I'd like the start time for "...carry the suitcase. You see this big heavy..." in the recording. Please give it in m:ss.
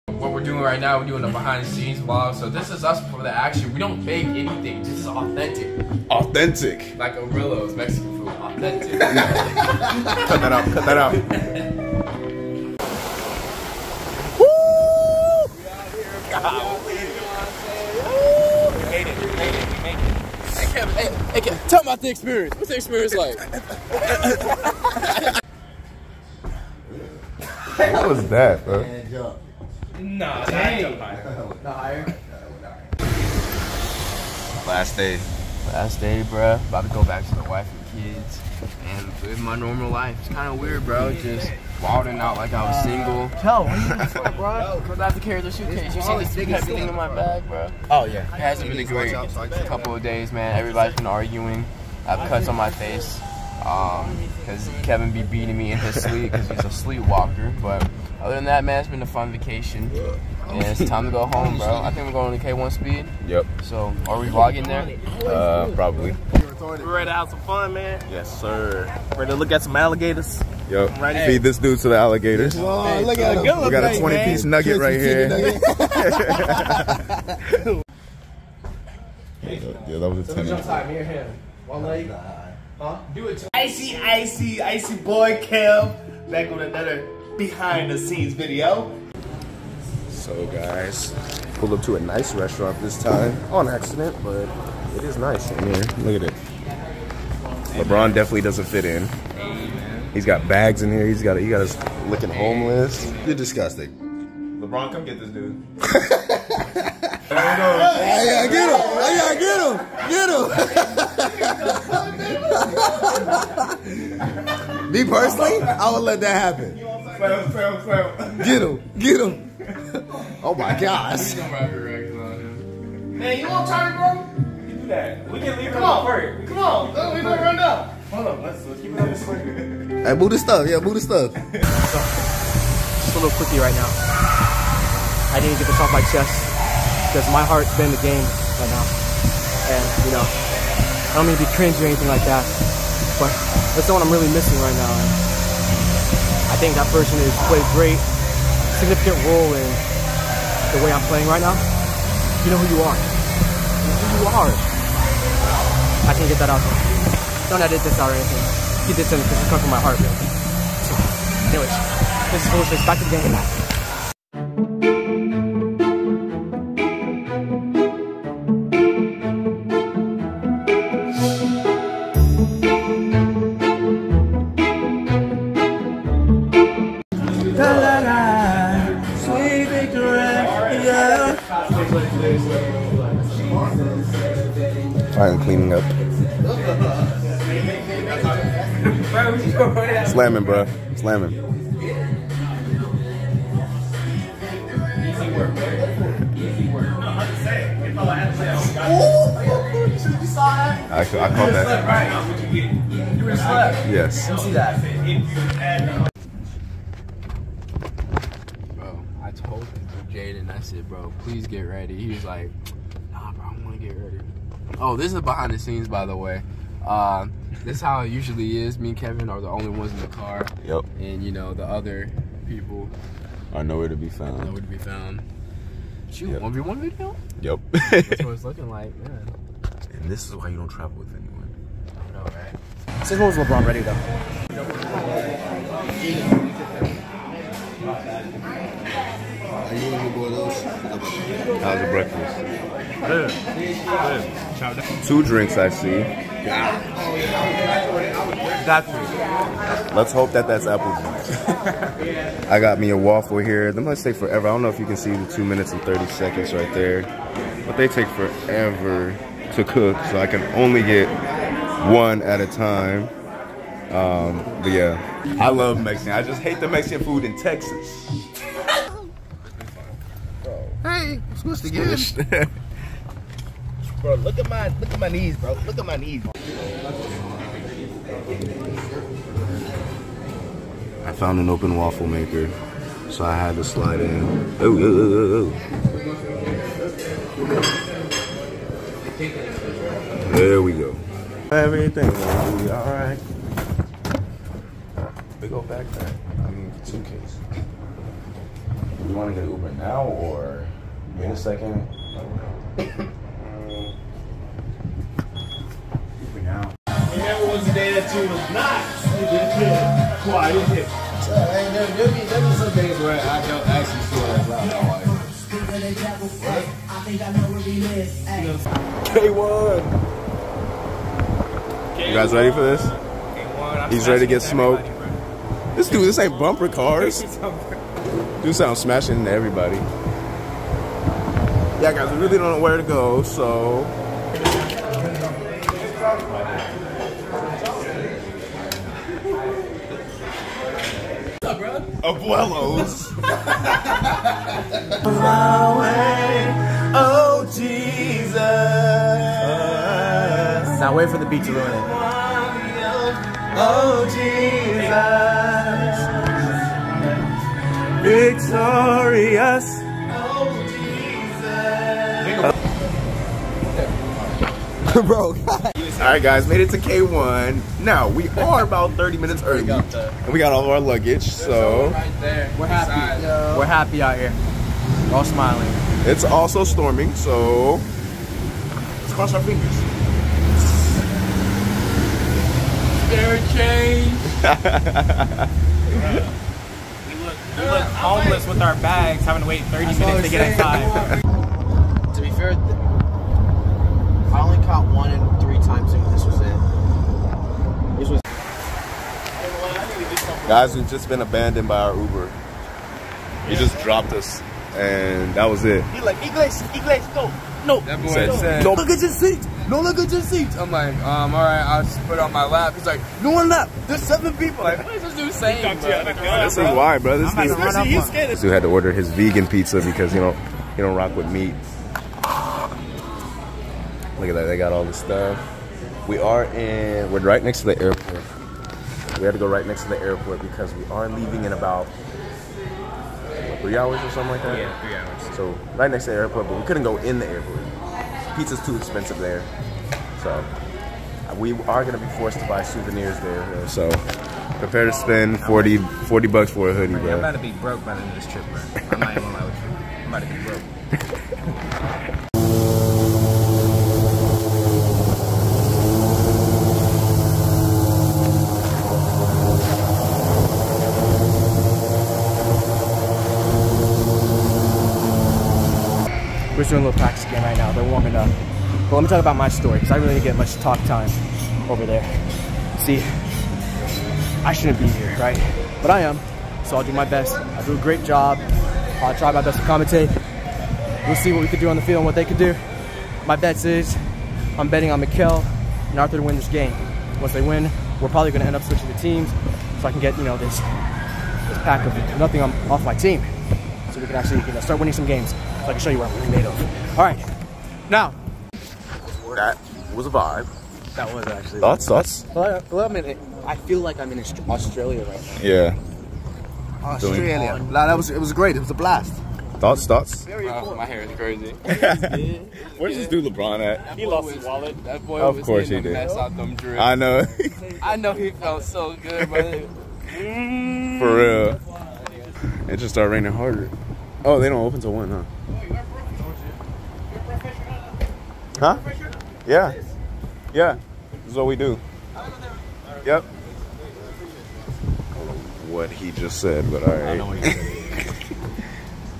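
0:45.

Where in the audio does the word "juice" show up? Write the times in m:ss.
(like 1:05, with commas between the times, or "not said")
4:12.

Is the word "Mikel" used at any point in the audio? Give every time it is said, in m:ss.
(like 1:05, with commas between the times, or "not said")
8:05.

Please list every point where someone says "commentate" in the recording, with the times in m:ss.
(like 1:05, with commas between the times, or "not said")
7:59.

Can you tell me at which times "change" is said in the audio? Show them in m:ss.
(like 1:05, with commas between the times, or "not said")
6:23.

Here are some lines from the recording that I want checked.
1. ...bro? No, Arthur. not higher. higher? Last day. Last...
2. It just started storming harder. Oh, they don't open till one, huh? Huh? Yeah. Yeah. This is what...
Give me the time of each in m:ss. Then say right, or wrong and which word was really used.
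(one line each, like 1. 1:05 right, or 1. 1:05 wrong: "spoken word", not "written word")
1. 0:28 wrong: "Dang", not "Arthur"
2. 8:42 wrong: "raining", not "storming".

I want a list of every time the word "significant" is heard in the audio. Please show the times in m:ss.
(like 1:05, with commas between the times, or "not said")
2:28.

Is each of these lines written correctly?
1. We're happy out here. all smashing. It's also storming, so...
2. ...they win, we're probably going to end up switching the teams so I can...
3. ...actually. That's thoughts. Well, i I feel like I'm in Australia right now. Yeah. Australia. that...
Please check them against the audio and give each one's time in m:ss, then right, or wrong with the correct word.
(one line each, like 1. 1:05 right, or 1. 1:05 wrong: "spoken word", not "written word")
1. 6:13 wrong: "smiling", not "smashing"
2. 8:07 right
3. 8:21 right.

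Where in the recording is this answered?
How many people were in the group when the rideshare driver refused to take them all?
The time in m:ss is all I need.
6:54.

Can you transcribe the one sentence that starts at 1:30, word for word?
So guys, pulled up to a nice restaurant this time.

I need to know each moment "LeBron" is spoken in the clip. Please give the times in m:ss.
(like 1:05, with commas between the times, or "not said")
1:37, 1:44, 3:53, 8:33.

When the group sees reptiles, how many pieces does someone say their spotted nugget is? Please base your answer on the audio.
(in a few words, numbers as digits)
20.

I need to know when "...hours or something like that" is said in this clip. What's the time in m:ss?
7:13.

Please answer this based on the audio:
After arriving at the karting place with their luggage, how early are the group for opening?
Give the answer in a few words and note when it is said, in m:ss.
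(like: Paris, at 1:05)
30 minutes, at 6:08.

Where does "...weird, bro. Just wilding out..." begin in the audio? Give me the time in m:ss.
0:40.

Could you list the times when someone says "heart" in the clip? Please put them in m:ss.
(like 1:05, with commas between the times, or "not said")
2:17, 2:39.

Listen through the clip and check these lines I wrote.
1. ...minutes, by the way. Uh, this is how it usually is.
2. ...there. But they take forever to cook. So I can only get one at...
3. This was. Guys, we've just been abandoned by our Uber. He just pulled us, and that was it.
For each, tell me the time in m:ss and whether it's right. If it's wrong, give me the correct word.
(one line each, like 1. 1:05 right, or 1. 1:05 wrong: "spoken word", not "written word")
1. 3:35 wrong: "scenes", not "minutes"
2. 4:16 right
3. 6:37 wrong: "dropped", not "pulled".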